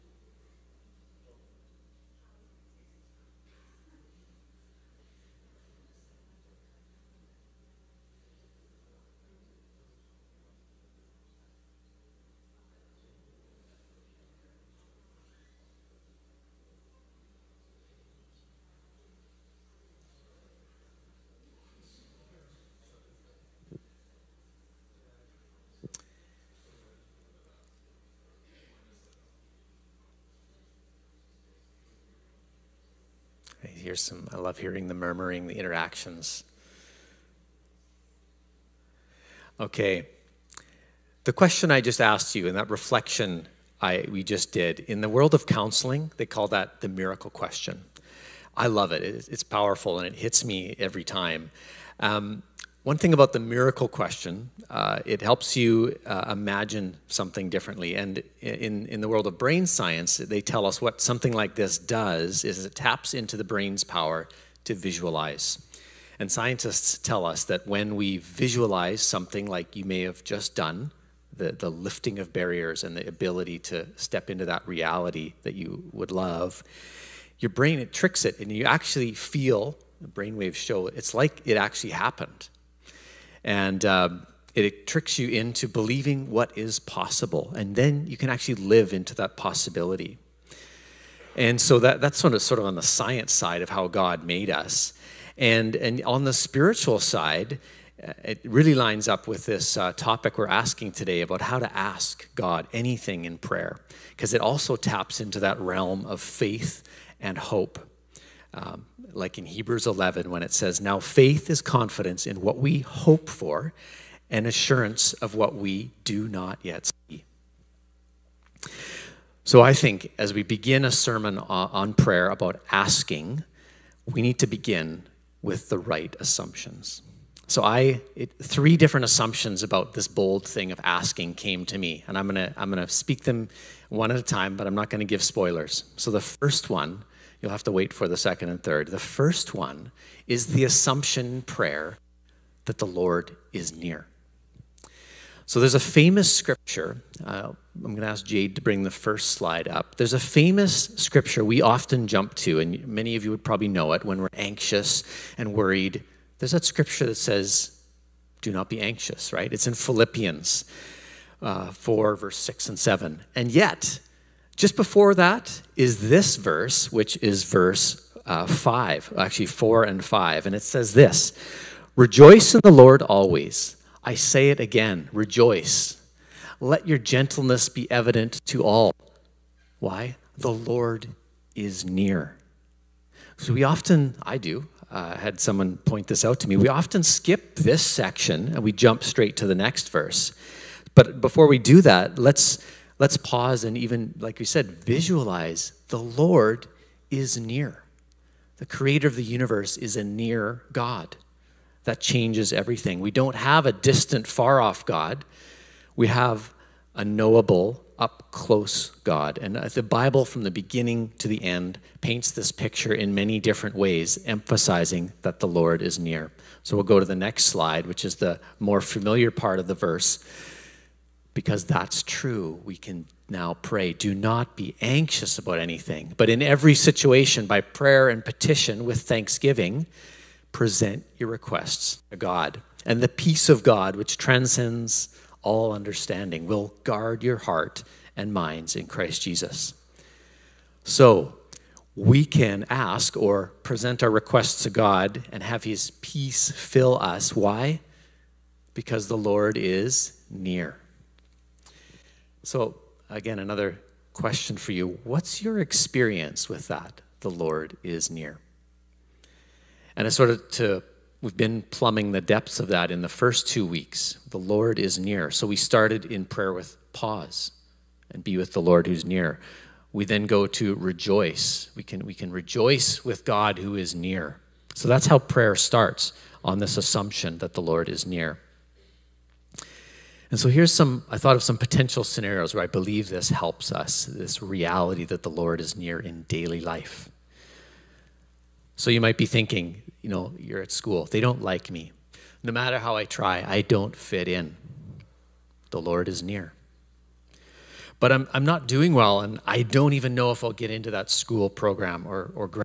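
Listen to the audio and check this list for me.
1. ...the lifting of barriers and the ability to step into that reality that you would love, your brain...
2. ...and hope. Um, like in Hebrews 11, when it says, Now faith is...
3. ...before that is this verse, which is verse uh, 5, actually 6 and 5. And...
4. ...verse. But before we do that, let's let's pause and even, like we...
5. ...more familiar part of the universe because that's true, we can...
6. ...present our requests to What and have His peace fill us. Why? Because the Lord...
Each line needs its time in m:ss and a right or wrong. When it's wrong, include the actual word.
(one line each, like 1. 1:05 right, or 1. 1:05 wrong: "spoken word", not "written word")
1. 1:11 right
2. 1:47 right
3. 2:44 wrong: "4", not "6"
4. 3:09 right
5. 3:38 wrong: "verse", not "universe"
6. 4:03 wrong: "God", not "What".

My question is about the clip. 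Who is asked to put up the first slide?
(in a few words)
Jade.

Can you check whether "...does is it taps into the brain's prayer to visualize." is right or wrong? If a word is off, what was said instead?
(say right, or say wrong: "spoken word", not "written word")
wrong: "power", not "prayer".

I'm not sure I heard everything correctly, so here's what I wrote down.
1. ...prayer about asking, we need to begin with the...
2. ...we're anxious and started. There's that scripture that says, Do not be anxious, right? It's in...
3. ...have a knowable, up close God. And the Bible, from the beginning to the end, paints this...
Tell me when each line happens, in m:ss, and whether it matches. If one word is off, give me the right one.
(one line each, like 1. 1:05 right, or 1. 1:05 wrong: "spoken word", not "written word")
1. 2:01 right
2. 2:34 wrong: "worried", not "started"
3. 3:26 right.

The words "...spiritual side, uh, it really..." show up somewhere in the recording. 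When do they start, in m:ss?
1:36.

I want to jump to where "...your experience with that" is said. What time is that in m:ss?
4:15.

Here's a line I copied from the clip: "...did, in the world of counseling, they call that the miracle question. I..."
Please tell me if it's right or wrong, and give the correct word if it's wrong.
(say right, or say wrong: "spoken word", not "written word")
right.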